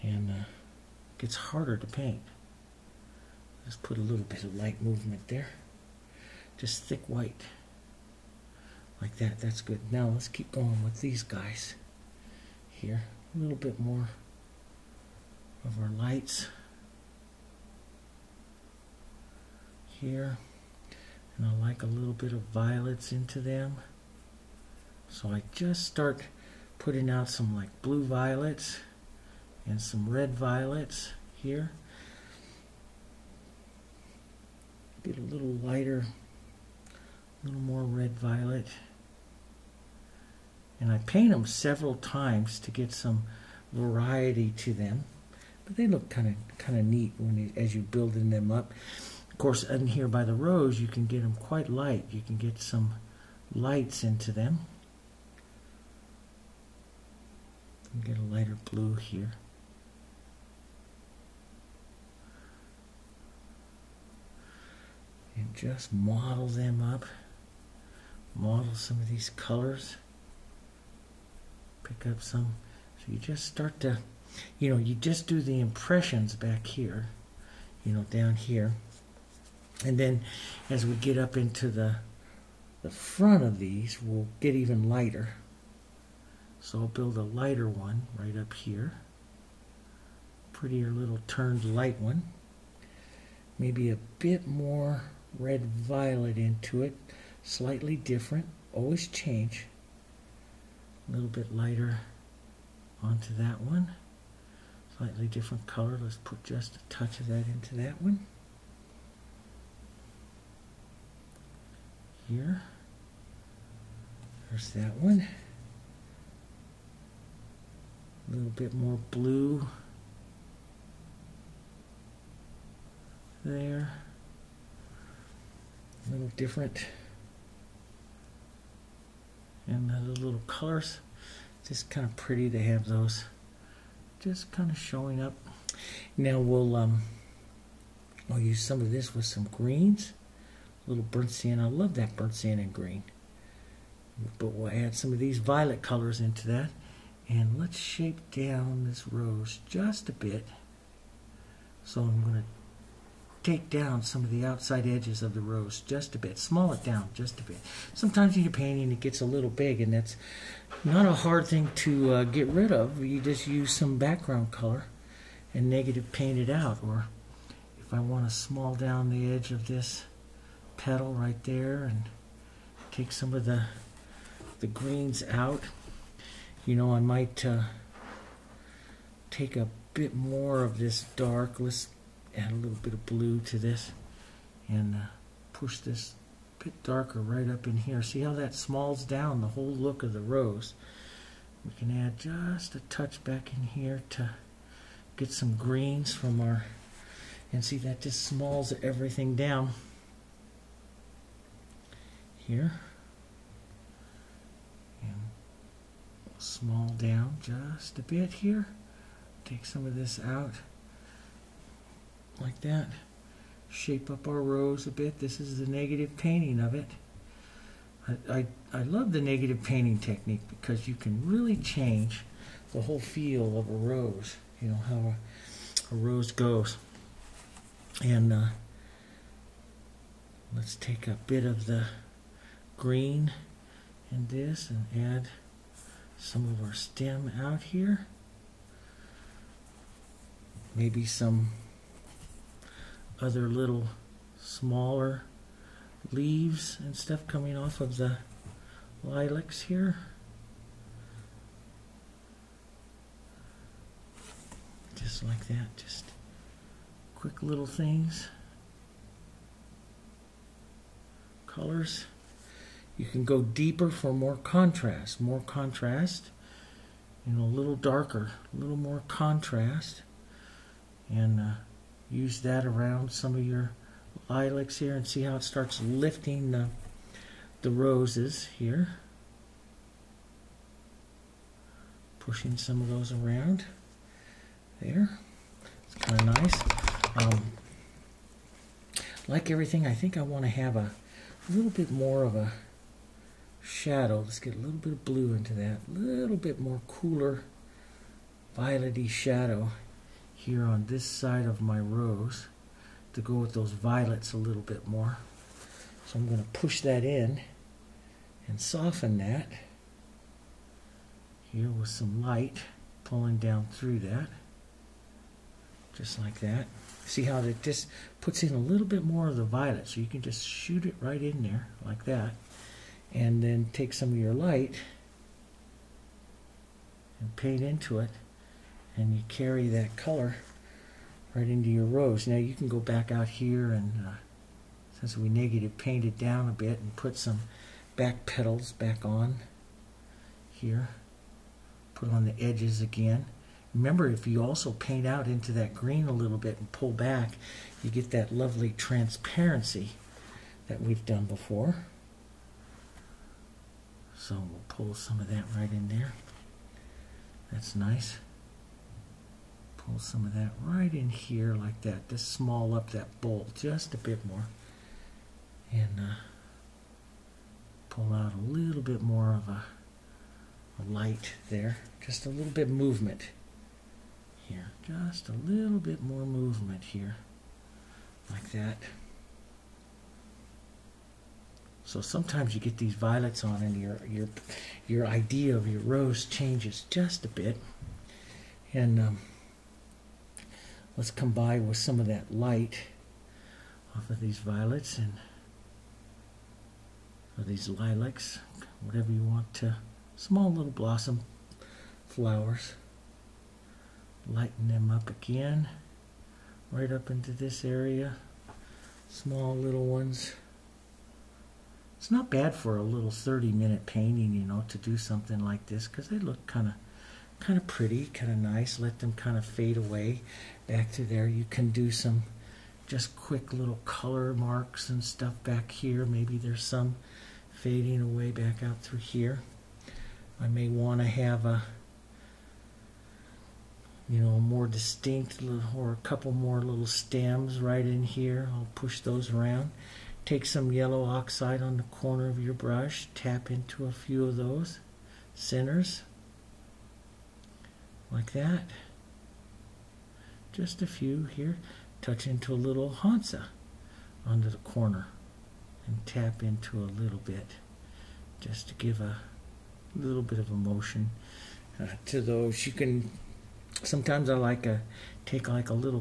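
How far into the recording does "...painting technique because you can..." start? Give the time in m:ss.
3:39.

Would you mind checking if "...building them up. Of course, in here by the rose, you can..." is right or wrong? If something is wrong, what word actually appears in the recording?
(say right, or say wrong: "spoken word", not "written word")
right.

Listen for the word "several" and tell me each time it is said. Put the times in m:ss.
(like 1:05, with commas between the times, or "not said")
0:41.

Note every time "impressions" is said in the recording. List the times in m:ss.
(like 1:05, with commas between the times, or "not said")
1:15.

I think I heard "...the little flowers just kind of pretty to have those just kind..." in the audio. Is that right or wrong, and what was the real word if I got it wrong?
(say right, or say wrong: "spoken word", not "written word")
wrong: "colors", not "flowers".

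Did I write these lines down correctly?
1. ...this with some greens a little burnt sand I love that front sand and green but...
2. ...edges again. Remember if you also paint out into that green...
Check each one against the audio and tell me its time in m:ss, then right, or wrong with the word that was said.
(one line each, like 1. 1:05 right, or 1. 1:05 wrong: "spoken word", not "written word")
1. 2:18 wrong: "burnt", not "front"
2. 5:42 right.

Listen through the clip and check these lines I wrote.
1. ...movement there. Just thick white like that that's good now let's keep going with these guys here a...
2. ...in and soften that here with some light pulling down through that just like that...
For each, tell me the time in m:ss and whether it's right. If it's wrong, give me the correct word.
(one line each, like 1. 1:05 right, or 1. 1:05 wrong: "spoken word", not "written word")
1. 0:04 right
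2. 5:07 right.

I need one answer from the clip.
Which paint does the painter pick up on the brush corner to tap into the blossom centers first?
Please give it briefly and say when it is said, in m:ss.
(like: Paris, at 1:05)
Yellow oxide, at 7:20.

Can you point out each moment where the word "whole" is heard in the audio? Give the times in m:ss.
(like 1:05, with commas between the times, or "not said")
3:09, 3:42.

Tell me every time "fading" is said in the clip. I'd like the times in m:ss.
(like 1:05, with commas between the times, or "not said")
7:07.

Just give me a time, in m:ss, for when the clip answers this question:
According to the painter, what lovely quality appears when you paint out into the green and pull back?
5:48.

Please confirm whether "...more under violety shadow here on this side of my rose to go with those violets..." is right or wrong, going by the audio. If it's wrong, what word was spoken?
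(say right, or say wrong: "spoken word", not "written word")
wrong: "cooler", not "under".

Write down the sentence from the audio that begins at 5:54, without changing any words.
So we'll pull some of that right in there.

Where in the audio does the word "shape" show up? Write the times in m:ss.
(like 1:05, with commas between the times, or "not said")
2:27, 3:33.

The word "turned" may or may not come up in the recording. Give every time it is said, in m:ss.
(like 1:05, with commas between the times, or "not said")
1:31.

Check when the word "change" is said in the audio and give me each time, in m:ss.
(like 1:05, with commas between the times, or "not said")
1:39, 3:41, 6:26.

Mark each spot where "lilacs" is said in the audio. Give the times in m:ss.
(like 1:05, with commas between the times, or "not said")
4:09, 4:34, 6:37.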